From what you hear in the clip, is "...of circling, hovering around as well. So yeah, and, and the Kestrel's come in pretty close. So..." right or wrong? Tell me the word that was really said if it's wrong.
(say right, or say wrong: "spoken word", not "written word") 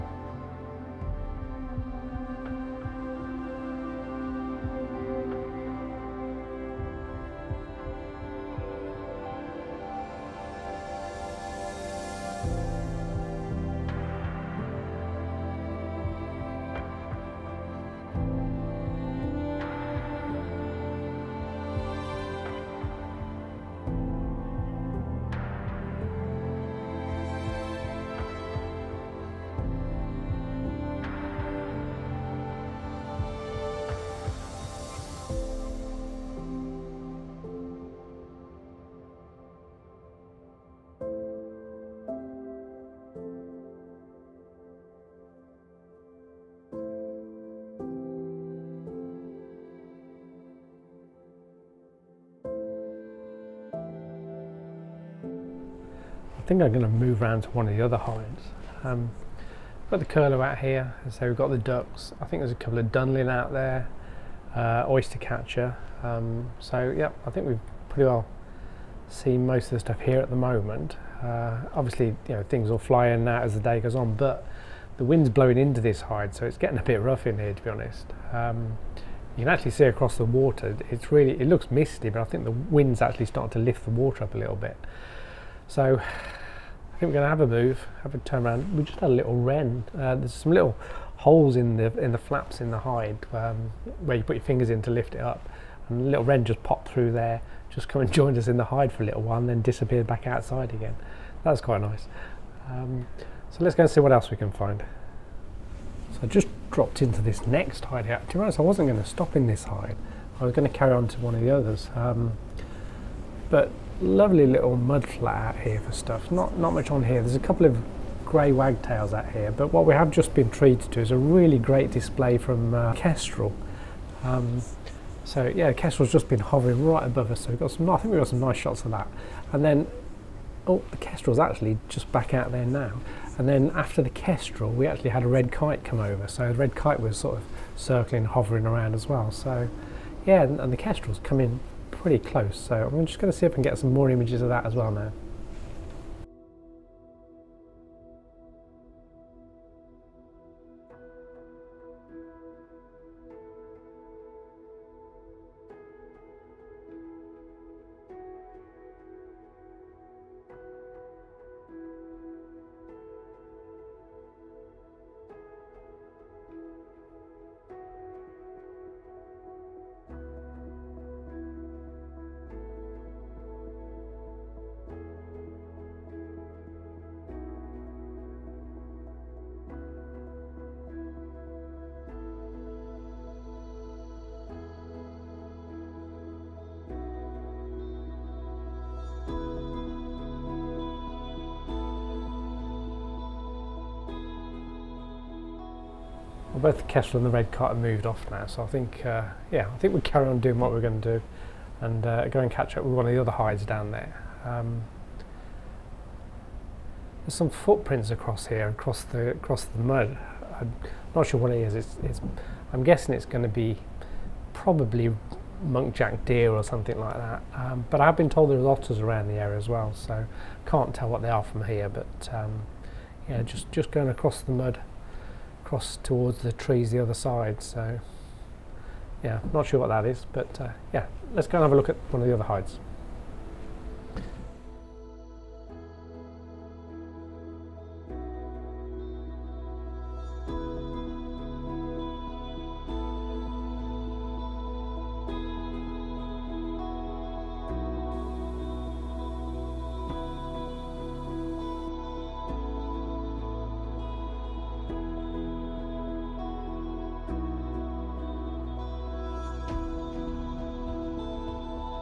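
right.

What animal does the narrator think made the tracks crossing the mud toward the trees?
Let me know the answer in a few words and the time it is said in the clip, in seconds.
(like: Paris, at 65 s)
muntjac deer, at 215 s.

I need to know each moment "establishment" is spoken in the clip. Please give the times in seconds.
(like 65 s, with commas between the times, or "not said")
not said.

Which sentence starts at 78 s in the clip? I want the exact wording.
Um, you can actually see across the water.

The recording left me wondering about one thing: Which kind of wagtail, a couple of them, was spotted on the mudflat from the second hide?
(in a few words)
grey wagtails.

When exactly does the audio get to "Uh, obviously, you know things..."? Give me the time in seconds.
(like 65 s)
71 s.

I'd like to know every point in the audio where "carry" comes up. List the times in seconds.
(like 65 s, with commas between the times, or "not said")
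110 s, 199 s.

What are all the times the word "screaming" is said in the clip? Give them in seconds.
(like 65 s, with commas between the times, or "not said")
not said.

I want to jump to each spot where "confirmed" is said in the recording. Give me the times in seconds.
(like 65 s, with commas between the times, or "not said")
not said.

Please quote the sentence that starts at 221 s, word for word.
But um, yeah, just just going across the mud across towards the trees the other side.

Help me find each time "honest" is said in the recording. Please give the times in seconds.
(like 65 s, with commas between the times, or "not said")
77 s, 108 s.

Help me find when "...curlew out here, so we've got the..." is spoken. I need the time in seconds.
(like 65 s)
60 s.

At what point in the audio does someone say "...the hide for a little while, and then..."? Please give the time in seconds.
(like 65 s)
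98 s.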